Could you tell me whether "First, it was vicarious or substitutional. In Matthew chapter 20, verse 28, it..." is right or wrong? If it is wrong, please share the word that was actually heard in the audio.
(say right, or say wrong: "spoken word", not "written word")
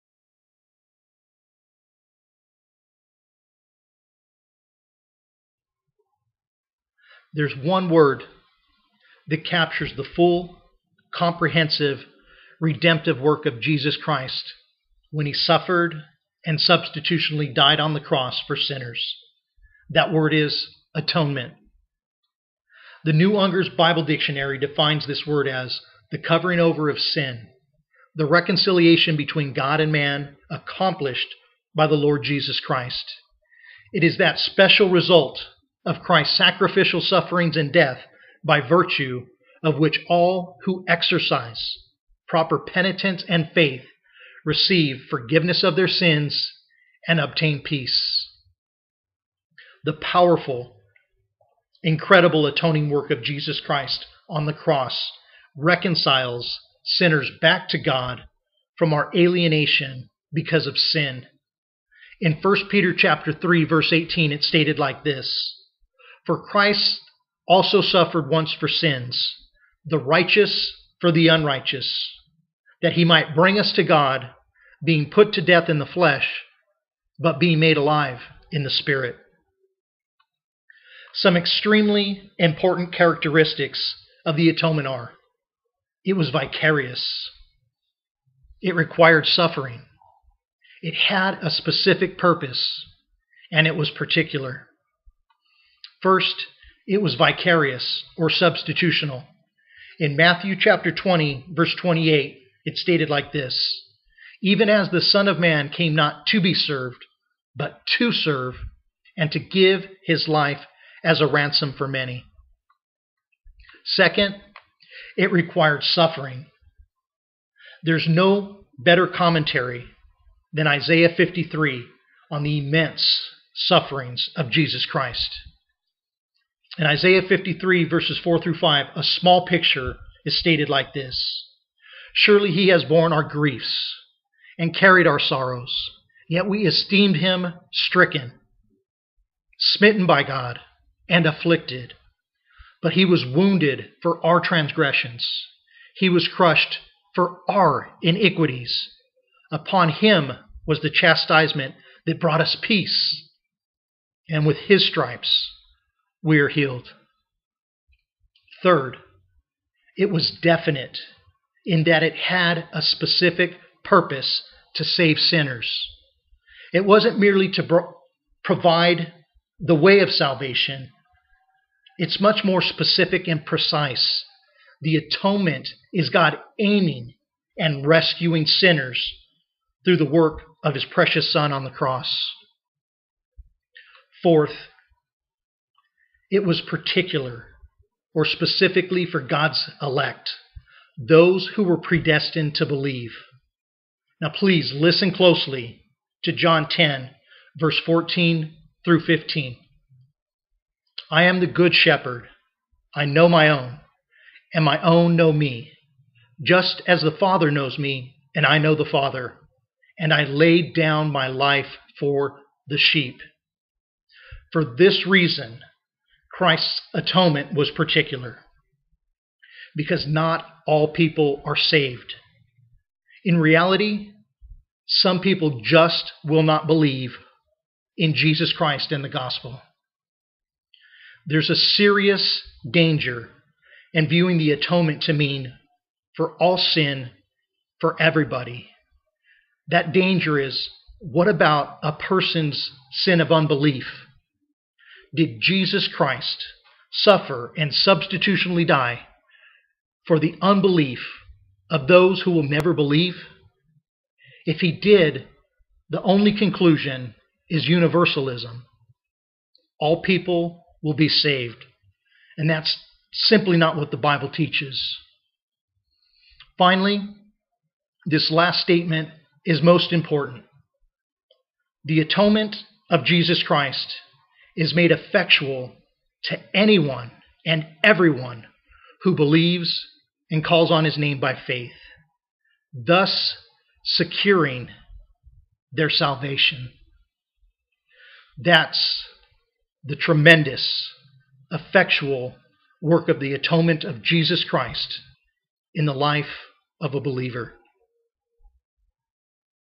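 right.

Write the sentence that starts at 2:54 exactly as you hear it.
The atonement is God aiming and rescuing sinners through the work of his precious Son on the cross.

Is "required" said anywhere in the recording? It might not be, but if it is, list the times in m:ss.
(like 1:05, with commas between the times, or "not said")
1:28, 1:55.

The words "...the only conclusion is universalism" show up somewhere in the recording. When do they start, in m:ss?
4:15.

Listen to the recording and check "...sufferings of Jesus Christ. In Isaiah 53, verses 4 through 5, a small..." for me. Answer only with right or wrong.
right.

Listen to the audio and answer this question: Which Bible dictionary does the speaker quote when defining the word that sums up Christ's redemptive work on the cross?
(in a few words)
The New Unger's Bible Dictionary.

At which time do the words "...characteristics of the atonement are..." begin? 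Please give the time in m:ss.
1:22.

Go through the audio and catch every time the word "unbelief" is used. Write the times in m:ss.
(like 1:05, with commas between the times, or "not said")
4:03, 4:10.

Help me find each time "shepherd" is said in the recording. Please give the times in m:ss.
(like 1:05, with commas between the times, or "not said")
3:21.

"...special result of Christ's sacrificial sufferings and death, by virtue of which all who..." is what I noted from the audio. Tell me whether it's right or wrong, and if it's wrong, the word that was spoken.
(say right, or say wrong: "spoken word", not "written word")
right.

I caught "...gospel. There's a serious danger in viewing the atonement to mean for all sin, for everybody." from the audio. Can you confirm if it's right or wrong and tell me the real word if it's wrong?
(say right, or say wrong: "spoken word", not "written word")
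right.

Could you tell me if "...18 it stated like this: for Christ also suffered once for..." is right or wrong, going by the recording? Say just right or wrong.
right.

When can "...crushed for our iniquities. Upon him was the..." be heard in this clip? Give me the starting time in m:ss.
2:26.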